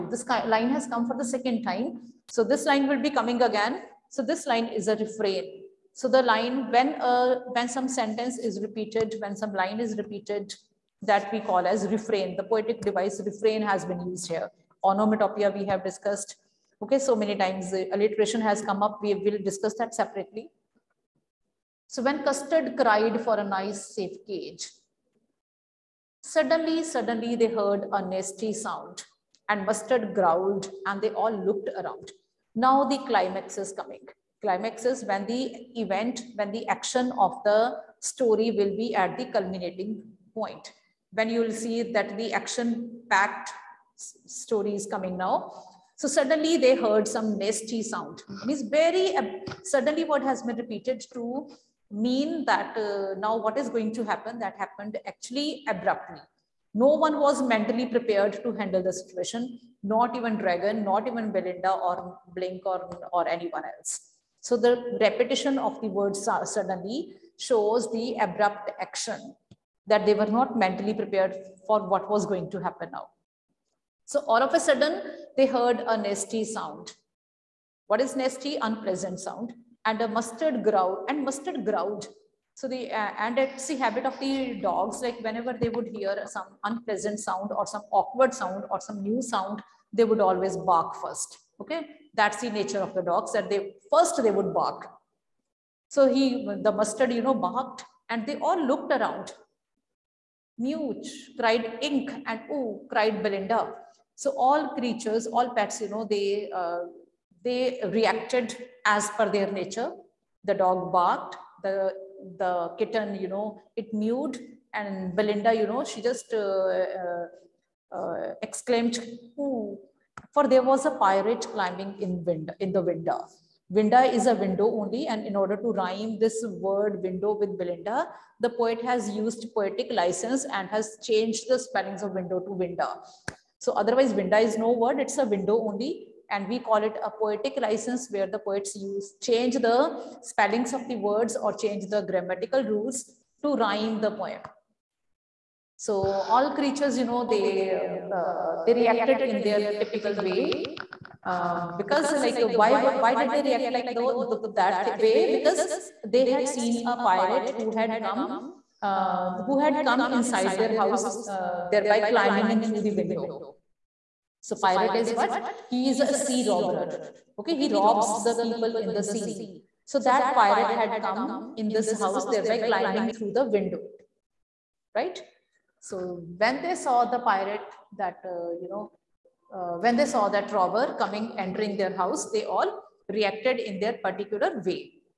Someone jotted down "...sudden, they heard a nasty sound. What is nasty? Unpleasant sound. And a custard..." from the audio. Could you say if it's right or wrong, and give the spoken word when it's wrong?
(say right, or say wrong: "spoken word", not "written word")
wrong: "mustard", not "custard".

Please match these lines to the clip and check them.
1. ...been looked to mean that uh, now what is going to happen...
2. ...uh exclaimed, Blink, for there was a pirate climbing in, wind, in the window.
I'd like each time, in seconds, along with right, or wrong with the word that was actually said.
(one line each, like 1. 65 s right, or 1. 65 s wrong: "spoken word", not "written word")
1. 50 s wrong: "repeated", not "looked"
2. 117 s wrong: "Ooh", not "Blink".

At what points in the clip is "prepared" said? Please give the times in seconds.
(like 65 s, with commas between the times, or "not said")
57 s, 70 s.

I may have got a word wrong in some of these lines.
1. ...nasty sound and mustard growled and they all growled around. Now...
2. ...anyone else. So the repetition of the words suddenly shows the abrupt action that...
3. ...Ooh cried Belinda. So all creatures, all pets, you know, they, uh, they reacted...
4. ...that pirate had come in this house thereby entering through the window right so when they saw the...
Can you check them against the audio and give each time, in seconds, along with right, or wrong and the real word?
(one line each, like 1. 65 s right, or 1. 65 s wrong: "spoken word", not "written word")
1. 28 s wrong: "looked", not "growled"
2. 63 s right
3. 102 s right
4. 170 s wrong: "climbing", not "entering".